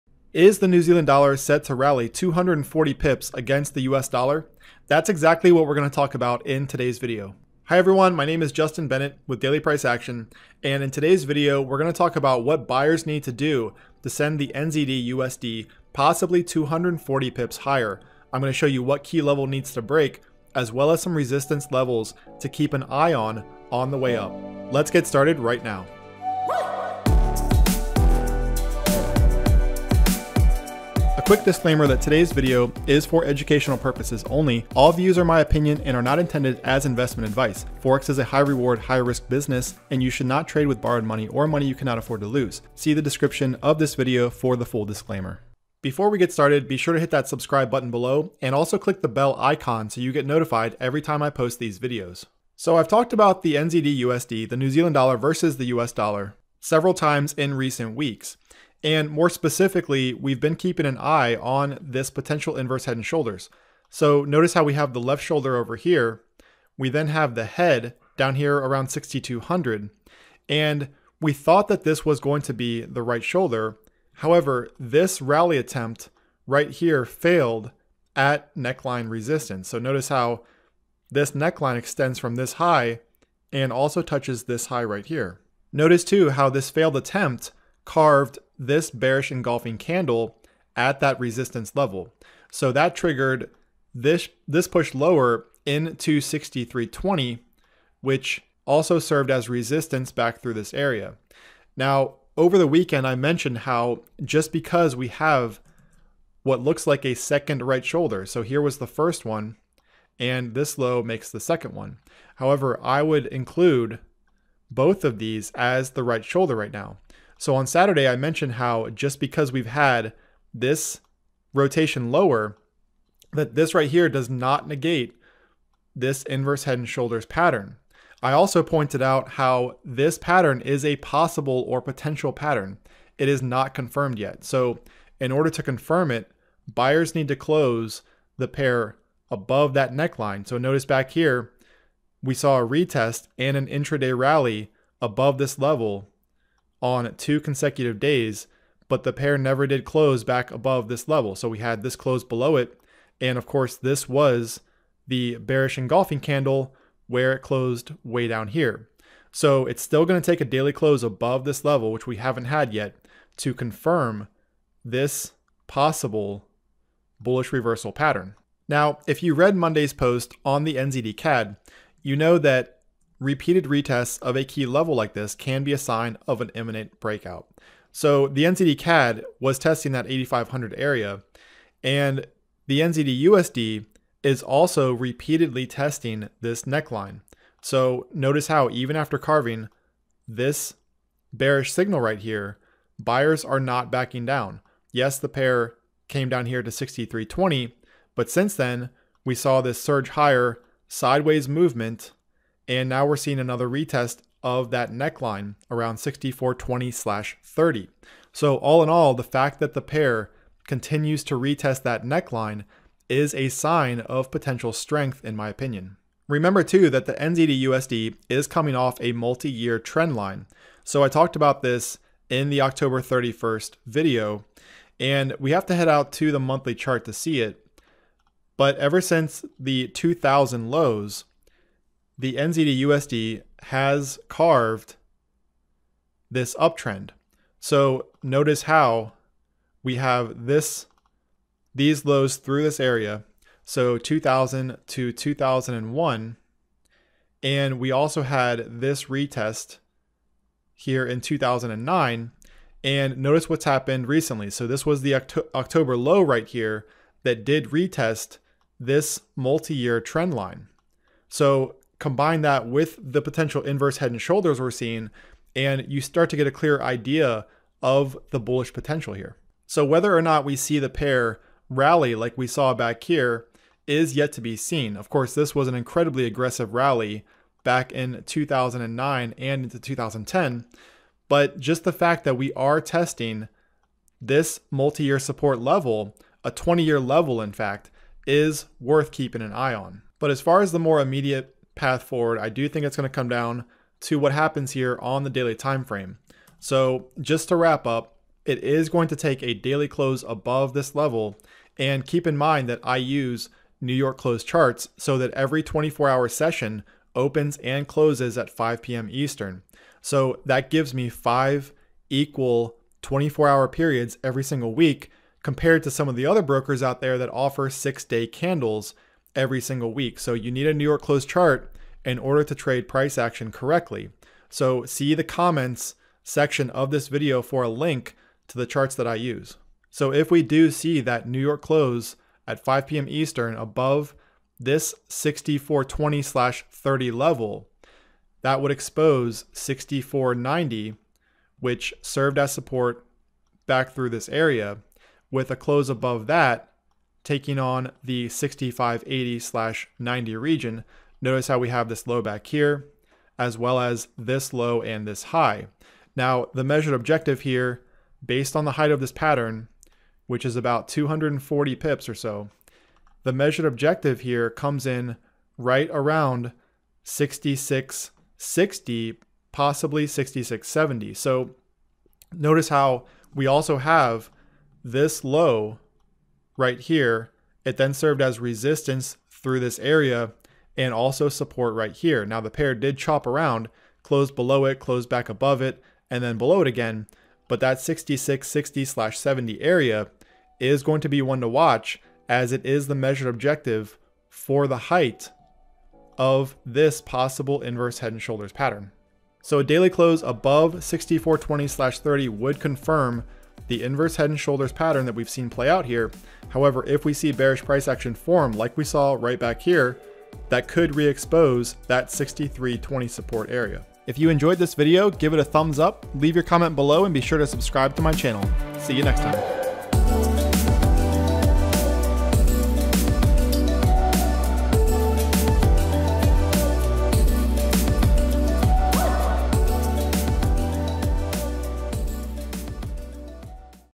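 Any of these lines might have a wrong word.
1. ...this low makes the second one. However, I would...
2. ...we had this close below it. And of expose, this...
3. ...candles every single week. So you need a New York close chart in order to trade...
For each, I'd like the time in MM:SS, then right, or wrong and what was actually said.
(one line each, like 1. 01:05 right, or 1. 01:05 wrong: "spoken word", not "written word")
1. 01:50 right
2. 02:31 wrong: "course", not "expose"
3. 05:18 right.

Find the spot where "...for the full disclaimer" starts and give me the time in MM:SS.
00:44.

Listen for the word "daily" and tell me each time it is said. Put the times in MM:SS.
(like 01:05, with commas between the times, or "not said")
00:09, 02:40, 04:55, 04:59, 06:39.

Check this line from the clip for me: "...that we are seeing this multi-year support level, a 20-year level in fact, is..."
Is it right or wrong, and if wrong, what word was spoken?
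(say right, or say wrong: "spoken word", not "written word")
wrong: "testing", not "seeing".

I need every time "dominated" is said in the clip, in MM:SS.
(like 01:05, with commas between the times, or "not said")
not said.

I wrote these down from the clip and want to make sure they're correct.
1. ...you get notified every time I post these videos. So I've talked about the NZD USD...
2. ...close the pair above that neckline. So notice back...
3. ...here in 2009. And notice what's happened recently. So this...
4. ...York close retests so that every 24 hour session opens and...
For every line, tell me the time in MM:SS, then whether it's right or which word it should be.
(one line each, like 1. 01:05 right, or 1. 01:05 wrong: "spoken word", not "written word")
1. 00:50 right
2. 02:17 right
3. 04:10 right
4. 05:03 wrong: "charts", not "retests".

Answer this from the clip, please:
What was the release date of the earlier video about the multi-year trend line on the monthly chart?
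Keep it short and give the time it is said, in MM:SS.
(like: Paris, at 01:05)
October 31st, at 03:42.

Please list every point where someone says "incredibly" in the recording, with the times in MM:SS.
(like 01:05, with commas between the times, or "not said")
04:35.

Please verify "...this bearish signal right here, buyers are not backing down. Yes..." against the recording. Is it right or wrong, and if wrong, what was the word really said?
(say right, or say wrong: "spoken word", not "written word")
right.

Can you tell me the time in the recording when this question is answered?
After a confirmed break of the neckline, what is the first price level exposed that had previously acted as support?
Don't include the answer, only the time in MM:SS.
05:39.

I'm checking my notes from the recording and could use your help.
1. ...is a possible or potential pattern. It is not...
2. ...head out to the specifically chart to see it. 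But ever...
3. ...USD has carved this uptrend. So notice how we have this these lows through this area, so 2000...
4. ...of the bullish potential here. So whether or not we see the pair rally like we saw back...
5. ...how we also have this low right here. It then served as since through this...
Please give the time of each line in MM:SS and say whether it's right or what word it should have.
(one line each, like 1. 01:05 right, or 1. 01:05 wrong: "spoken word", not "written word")
1. 02:10 right
2. 03:45 wrong: "monthly", not "specifically"
3. 03:52 right
4. 04:27 right
5. 06:12 wrong: "resistance", not "since".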